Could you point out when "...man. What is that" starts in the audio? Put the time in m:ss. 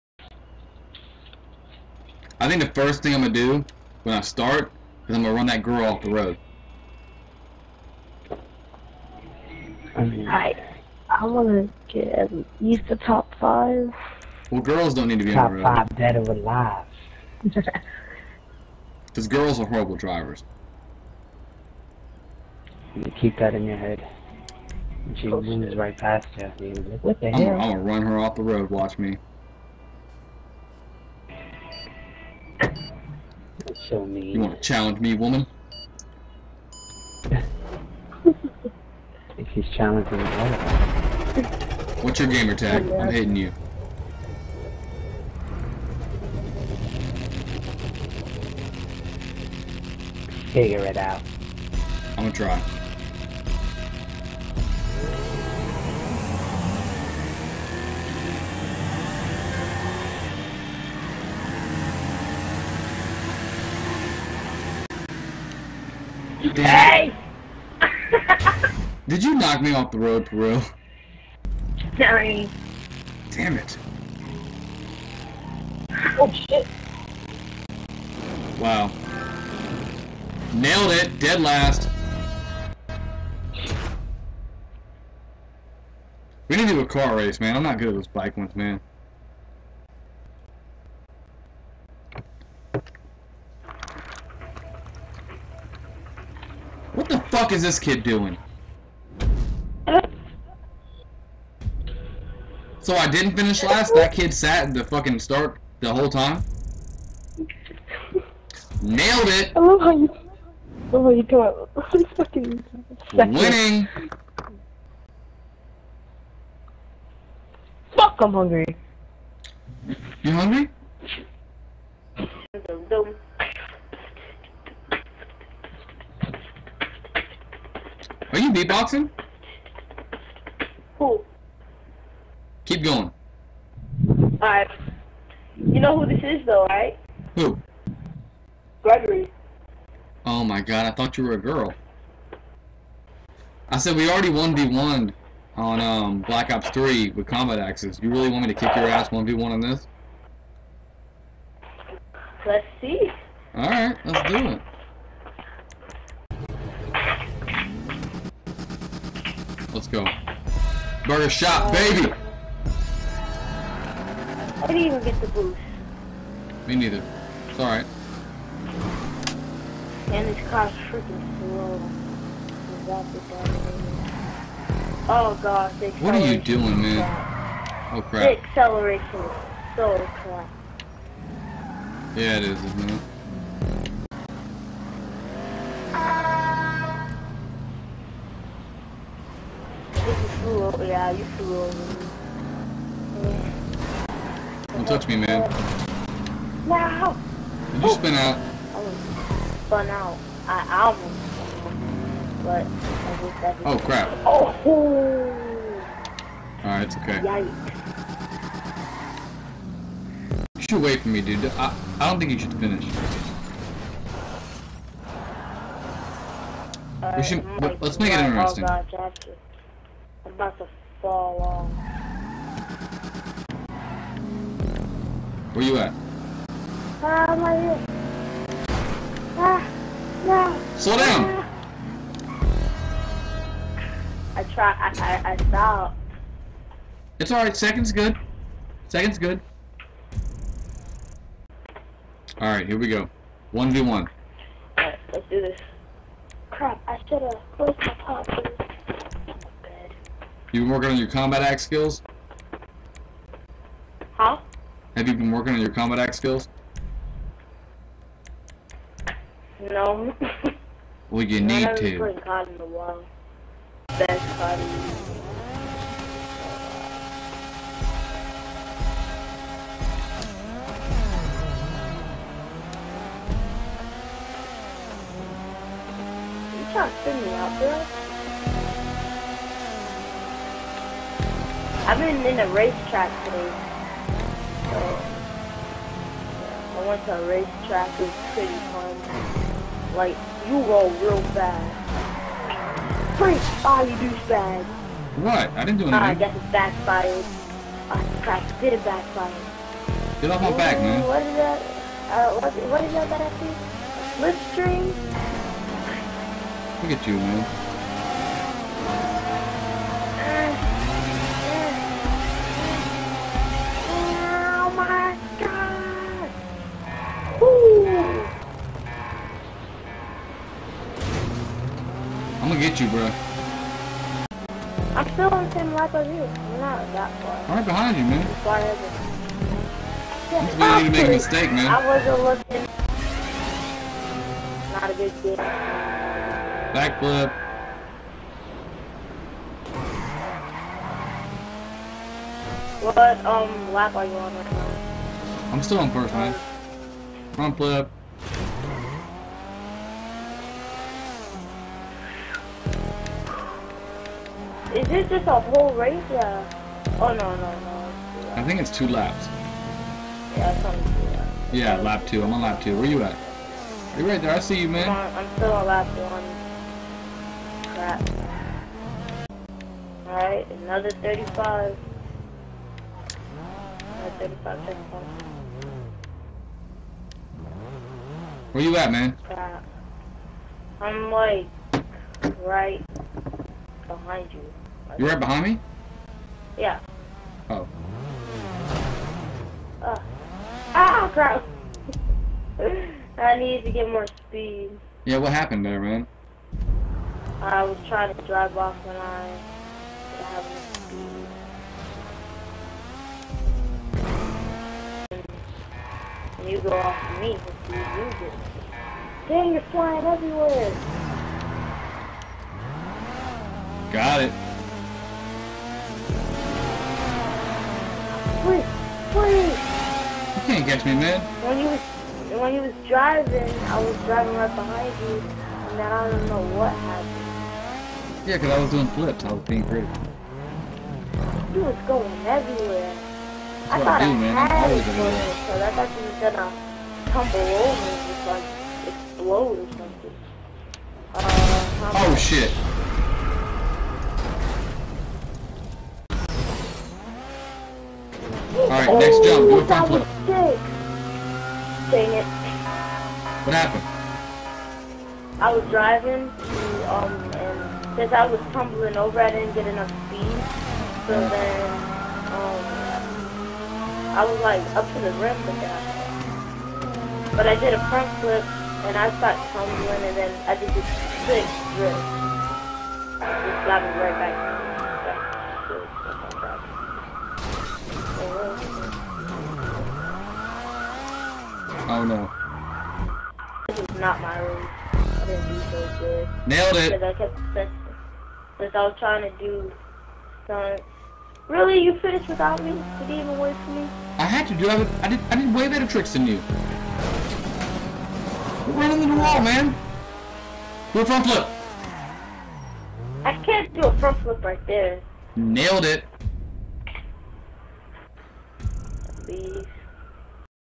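5:00.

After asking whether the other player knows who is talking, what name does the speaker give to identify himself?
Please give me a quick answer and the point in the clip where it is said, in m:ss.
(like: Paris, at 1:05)
Gregory, at 2:18.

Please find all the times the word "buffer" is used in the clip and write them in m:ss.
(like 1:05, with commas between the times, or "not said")
not said.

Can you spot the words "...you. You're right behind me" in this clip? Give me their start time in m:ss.
6:24.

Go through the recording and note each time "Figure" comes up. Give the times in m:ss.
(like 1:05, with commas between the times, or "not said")
0:50.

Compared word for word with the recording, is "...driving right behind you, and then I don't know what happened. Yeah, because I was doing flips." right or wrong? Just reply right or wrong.
right.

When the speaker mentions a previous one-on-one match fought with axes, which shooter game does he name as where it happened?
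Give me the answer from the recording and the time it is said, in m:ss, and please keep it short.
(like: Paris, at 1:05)
Black Ops 3, at 2:26.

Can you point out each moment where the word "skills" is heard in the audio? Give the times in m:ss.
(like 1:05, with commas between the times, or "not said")
4:11, 4:16.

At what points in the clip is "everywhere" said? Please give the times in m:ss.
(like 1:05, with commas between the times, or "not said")
6:50, 7:12.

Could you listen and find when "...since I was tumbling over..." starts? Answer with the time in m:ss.
7:37.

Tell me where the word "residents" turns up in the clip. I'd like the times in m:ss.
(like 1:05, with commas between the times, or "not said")
not said.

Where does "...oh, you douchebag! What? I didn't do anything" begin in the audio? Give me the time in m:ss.
4:53.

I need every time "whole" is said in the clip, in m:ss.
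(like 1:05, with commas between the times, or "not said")
1:45, 5:55.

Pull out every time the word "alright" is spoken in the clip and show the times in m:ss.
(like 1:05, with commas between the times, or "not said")
2:14, 2:33, 2:47, 3:26, 6:10, 7:28.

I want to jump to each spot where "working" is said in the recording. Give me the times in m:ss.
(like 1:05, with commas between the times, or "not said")
4:10, 4:15.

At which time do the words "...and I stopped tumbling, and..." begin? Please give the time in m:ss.
7:48.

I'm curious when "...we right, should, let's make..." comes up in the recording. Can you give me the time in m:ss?
3:37.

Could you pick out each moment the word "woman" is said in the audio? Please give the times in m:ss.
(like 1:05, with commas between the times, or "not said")
0:35.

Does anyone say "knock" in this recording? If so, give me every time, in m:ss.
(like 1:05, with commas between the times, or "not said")
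1:09.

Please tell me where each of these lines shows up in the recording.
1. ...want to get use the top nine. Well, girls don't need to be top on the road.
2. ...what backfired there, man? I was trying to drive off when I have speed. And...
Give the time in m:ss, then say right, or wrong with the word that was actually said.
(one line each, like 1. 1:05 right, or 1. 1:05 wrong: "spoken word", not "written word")
1. 0:11 wrong: "five", not "nine"
2. 6:35 wrong: "happened", not "backfired".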